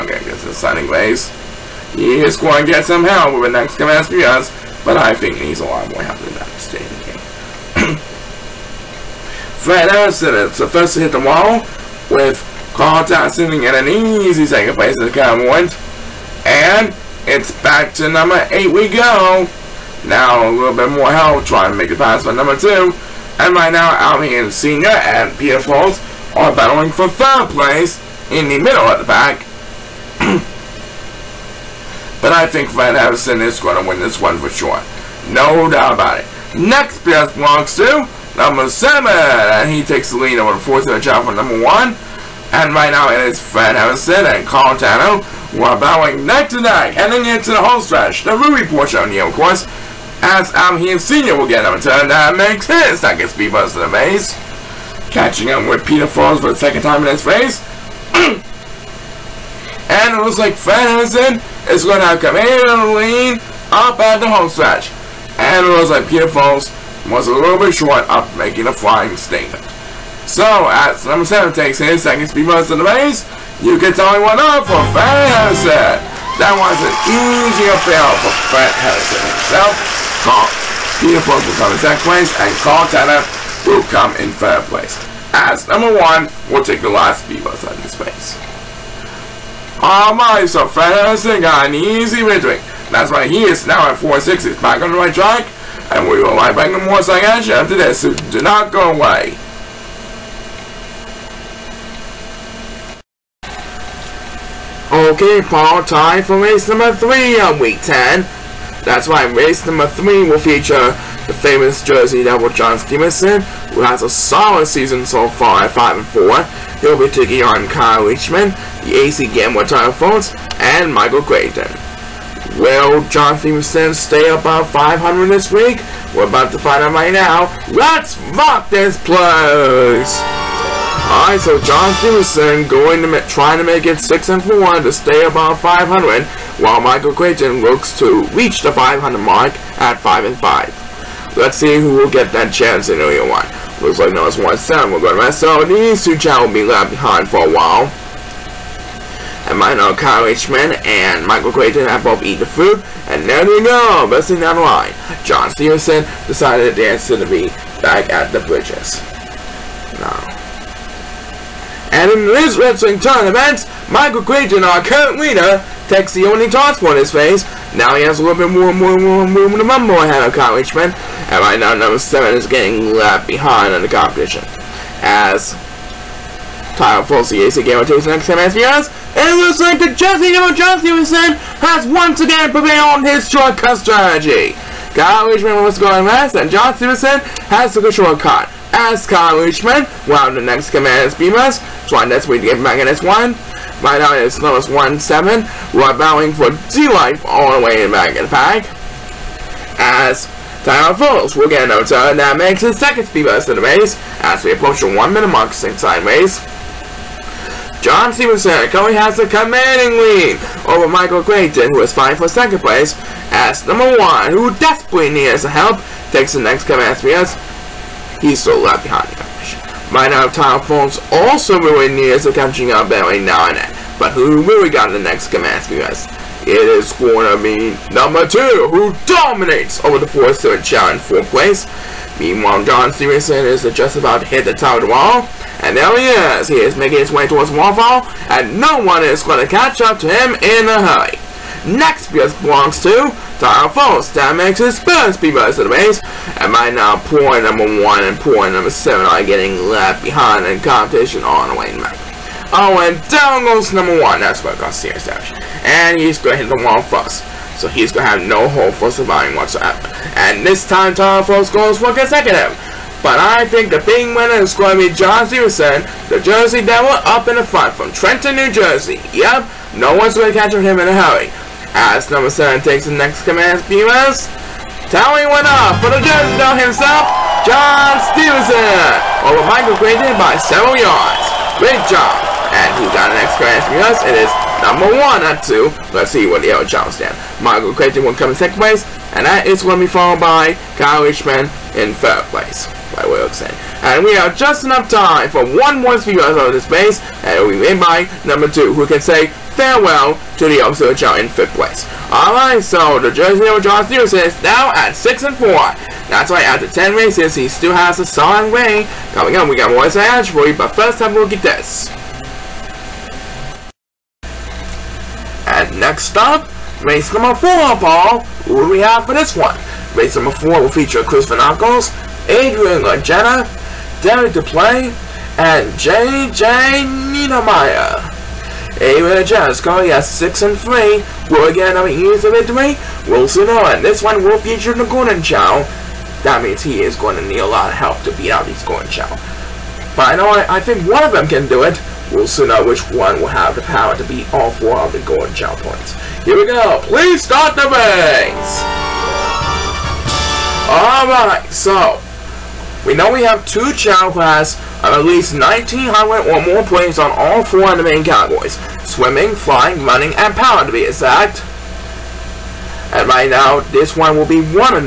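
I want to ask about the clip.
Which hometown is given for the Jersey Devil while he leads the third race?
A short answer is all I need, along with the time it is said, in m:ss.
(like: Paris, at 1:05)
Trenton, New Jersey, at 4:27.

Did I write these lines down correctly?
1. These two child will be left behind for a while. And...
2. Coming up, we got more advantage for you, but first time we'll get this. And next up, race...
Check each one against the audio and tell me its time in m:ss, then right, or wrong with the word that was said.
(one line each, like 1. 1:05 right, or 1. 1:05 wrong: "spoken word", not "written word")
1. 2:25 right
2. 5:09 right.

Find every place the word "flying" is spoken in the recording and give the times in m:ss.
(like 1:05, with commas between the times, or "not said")
1:08, 5:59.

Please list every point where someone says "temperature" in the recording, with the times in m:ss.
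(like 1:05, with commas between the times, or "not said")
not said.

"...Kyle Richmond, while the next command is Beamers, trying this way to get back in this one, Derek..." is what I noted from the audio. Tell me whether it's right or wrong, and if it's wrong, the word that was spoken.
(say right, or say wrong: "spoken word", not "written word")
wrong: "Right", not "Derek".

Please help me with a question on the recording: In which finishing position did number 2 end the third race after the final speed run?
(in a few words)
Fifth place.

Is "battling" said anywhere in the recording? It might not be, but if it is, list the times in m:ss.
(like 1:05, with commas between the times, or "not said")
0:26, 3:15.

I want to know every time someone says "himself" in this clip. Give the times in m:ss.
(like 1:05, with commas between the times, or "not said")
1:19, 4:36.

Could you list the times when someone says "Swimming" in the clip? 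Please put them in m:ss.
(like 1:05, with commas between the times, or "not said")
5:58.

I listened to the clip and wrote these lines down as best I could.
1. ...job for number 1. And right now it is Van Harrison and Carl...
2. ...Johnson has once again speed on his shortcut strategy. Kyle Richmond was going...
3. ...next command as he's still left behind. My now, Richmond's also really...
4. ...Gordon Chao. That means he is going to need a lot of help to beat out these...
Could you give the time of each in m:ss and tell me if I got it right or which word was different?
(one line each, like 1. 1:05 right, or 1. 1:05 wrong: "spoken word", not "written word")
1. 0:41 right
2. 3:00 wrong: "prevailed", not "speed"
3. 3:36 wrong: "Tylephone", not "Richmond"
4. 5:34 right.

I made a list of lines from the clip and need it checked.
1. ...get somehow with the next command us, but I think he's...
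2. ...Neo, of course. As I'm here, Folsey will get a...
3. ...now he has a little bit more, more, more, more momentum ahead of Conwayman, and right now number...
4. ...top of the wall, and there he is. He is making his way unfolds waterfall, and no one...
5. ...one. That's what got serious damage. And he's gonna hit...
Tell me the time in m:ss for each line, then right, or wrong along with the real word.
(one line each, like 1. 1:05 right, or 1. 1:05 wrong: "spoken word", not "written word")
1. 0:02 right
2. 0:49 wrong: "Senior", not "Folsey"
3. 2:47 right
4. 3:54 wrong: "towards", not "unfolds"
5. 4:13 right.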